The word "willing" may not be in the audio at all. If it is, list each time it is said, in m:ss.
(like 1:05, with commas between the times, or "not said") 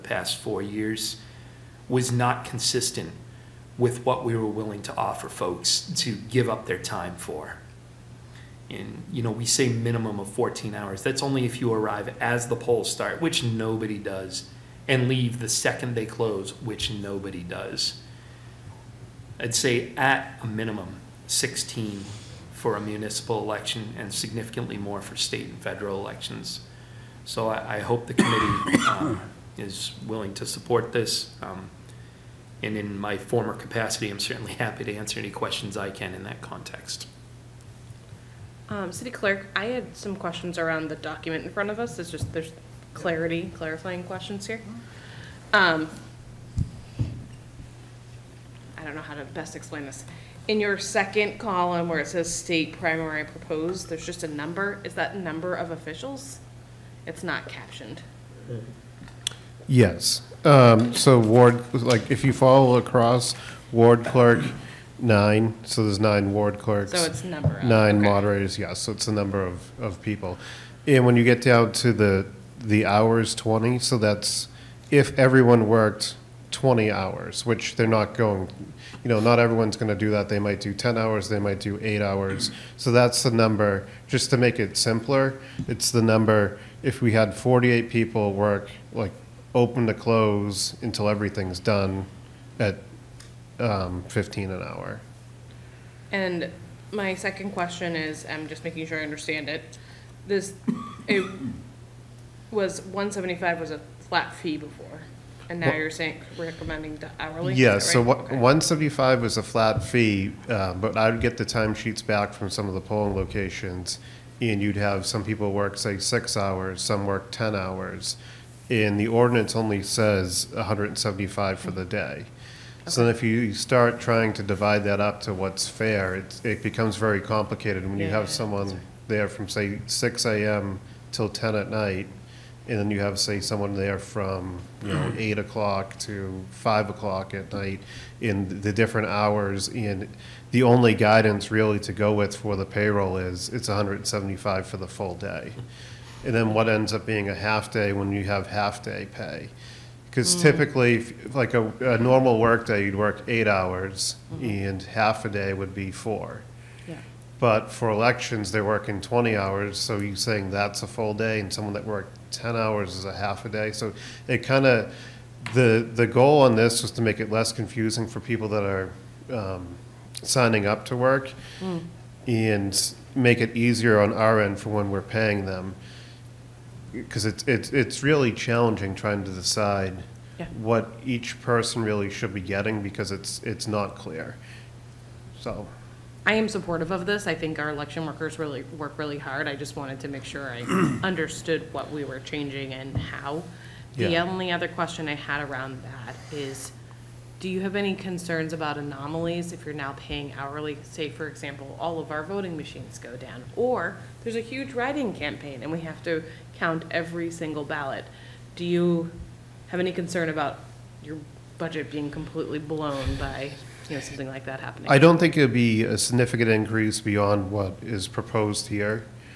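0:04, 0:30.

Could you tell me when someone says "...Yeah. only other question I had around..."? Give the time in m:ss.
3:14.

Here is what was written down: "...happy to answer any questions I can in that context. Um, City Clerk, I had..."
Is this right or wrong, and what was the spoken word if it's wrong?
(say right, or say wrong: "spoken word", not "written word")
right.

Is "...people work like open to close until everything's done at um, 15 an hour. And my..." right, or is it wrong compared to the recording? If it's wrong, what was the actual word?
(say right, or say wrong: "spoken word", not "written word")
right.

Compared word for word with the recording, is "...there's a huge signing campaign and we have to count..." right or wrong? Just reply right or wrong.
wrong.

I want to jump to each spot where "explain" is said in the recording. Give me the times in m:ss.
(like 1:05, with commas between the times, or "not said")
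0:49.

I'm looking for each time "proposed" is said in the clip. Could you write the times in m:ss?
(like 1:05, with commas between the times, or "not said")
0:53, 3:38.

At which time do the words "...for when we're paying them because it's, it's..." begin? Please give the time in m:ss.
2:54.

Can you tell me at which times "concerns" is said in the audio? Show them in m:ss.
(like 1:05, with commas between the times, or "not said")
3:17, 3:29.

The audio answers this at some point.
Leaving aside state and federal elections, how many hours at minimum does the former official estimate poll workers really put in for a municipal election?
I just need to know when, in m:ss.
0:21.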